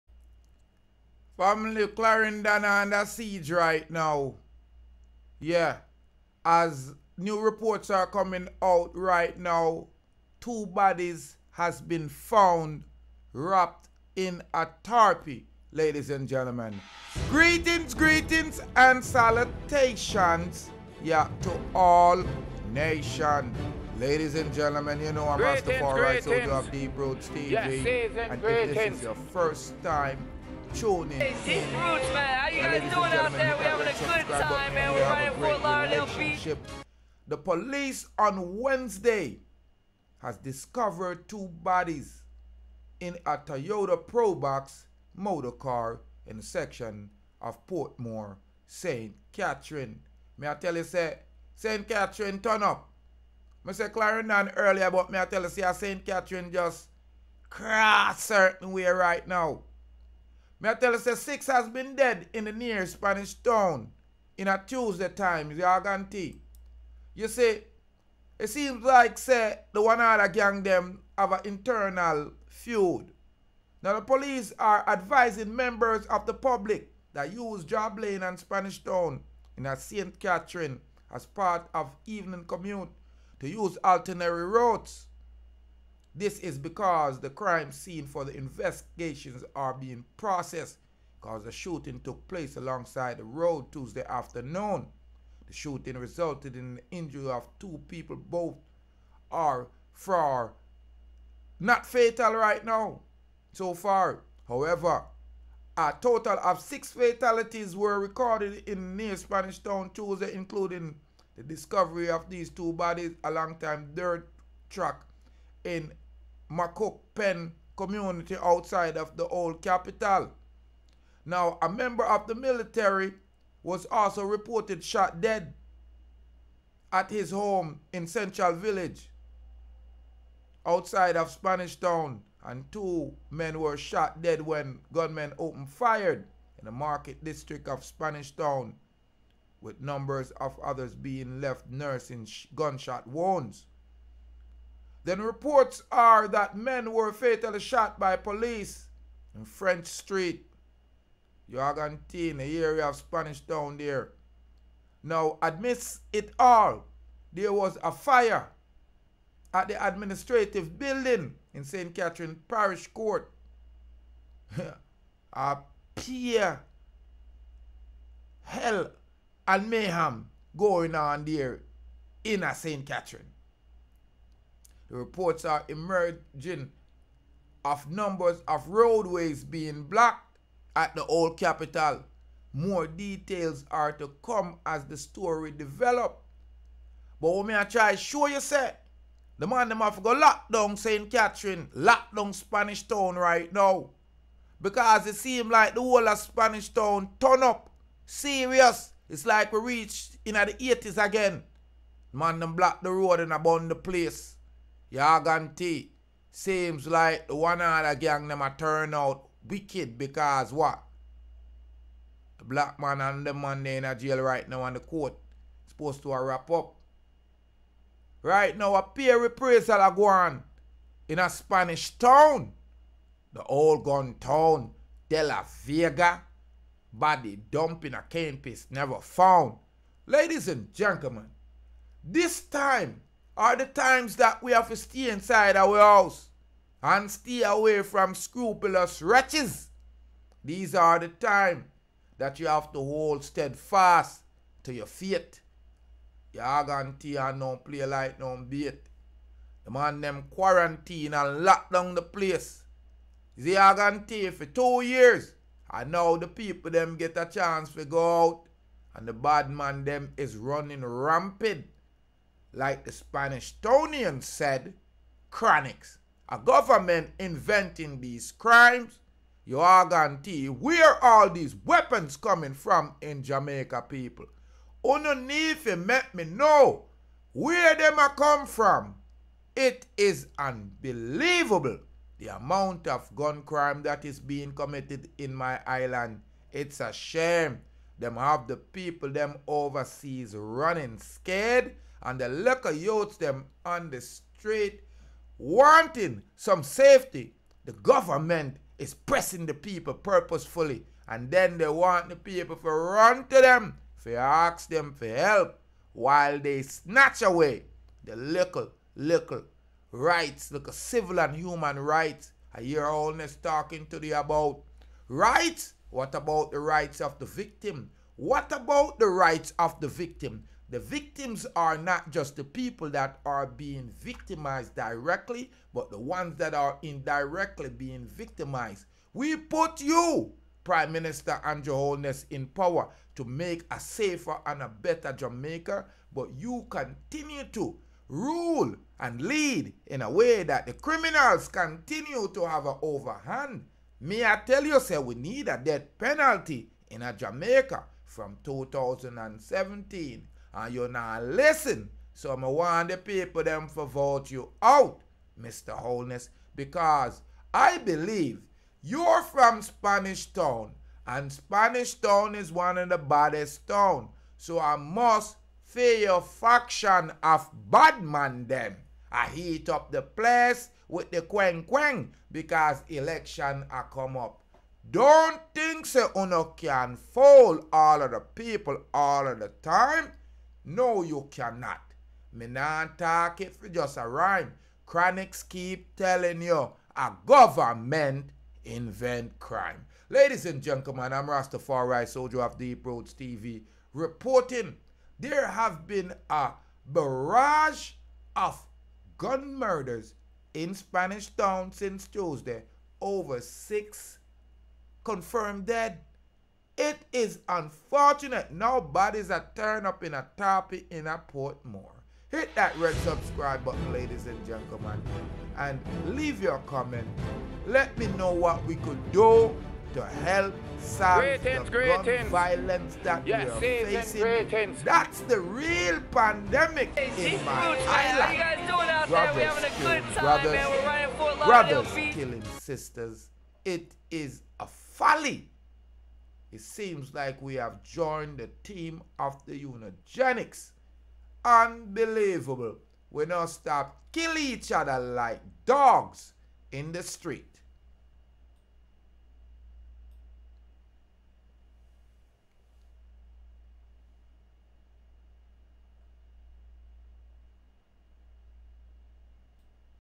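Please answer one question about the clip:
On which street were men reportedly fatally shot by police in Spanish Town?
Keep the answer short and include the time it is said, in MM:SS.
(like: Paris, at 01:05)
French Street, at 02:29.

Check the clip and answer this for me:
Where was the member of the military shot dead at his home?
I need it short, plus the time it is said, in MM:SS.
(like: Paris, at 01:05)
Central Village, at 02:08.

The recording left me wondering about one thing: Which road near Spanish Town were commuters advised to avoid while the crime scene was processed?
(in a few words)
Job Lane.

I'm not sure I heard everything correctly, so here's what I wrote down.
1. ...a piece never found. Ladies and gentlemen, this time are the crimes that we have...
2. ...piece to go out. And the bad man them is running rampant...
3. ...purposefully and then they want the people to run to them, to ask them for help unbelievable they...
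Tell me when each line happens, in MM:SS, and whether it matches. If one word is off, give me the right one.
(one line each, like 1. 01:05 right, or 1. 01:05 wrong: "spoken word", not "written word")
1. 03:47 wrong: "times", not "crimes"
2. 04:17 wrong: "chance", not "piece"
3. 04:59 wrong: "while", not "unbelievable".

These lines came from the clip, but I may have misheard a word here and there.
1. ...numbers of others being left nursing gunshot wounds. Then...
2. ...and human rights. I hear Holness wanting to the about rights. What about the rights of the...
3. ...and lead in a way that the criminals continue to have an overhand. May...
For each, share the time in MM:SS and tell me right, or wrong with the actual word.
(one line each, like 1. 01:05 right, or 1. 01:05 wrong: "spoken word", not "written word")
1. 02:19 right
2. 05:11 wrong: "talking", not "wanting"
3. 05:39 right.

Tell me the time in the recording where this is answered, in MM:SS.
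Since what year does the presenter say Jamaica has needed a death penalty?
05:48.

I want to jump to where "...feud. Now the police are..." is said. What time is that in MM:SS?
01:12.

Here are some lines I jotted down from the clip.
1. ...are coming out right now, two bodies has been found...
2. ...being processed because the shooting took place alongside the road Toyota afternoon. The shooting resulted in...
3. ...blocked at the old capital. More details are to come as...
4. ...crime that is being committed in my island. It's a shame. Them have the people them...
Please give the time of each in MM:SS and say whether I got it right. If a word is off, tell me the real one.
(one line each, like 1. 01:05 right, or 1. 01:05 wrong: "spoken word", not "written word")
1. 00:07 right
2. 01:29 wrong: "Tuesday", not "Toyota"
3. 02:59 right
4. 04:43 right.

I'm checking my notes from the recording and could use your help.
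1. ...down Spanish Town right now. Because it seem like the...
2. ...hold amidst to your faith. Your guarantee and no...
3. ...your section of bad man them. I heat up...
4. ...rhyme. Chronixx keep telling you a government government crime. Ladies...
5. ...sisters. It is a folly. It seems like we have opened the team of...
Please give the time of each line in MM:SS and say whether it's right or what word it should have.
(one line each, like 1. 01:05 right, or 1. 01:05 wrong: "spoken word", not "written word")
1. 03:12 right
2. 04:02 wrong: "steadfast", not "amidst"
3. 06:05 wrong: "faction", not "section"
4. 06:24 wrong: "invent", not "government"
5. 07:12 wrong: "joined", not "opened".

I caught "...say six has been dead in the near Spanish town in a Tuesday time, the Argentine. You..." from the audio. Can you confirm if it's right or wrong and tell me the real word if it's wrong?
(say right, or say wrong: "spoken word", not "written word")
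right.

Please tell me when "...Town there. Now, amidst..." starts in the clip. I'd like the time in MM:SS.
02:33.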